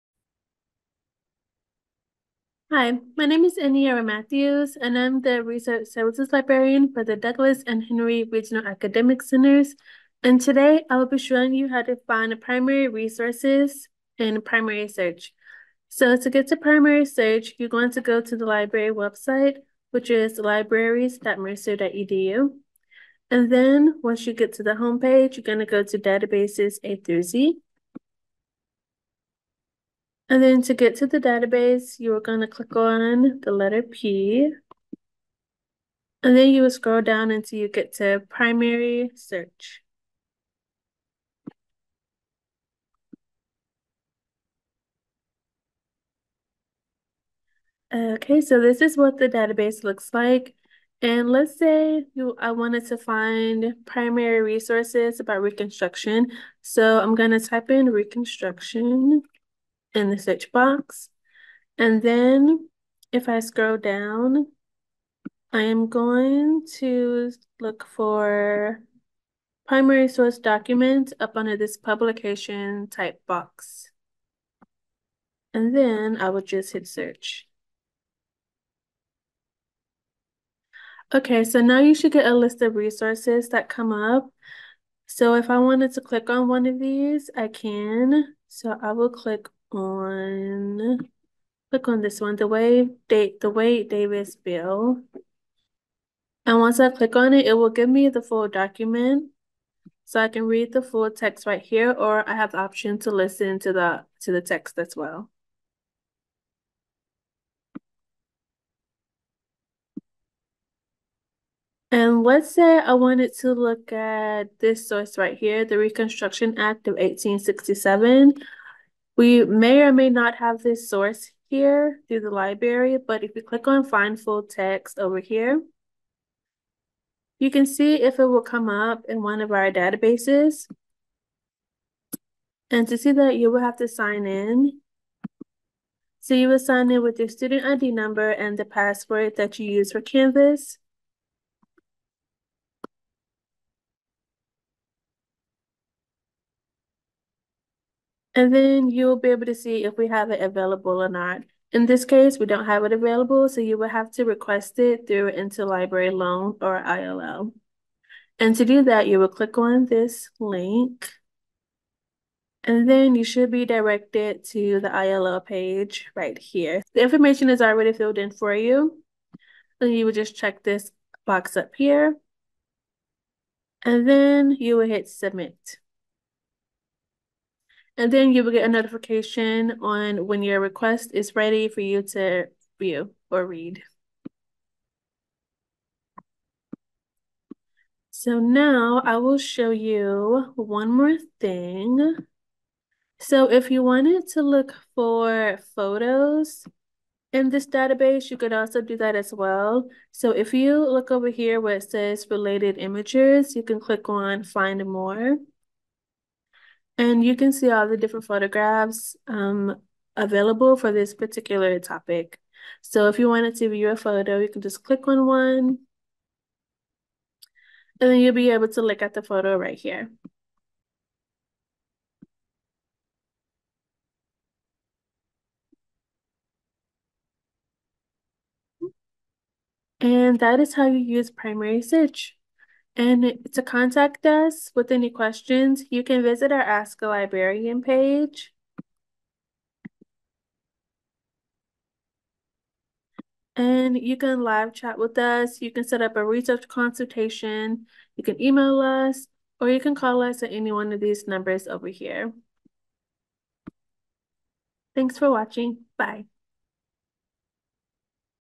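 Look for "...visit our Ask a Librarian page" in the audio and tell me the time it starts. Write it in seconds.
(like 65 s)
236 s.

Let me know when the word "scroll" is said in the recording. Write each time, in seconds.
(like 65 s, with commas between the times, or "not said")
36 s, 63 s.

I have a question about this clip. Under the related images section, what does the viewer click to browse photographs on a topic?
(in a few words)
find more.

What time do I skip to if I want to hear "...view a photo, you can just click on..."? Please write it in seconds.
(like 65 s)
213 s.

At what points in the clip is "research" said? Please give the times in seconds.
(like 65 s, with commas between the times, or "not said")
5 s, 246 s.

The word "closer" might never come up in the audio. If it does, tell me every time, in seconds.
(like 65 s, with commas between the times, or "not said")
not said.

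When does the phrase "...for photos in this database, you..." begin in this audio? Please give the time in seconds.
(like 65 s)
194 s.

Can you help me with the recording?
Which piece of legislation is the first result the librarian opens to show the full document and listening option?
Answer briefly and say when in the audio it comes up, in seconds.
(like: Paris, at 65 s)
Wade-Davis bill, at 93 s.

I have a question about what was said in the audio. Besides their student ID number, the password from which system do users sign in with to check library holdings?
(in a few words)
Canvas.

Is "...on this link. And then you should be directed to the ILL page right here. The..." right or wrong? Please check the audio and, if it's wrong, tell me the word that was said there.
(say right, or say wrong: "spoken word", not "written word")
right.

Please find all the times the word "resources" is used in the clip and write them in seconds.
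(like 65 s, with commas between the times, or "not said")
12 s, 54 s, 82 s.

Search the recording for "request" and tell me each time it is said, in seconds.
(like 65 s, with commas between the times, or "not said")
154 s, 180 s.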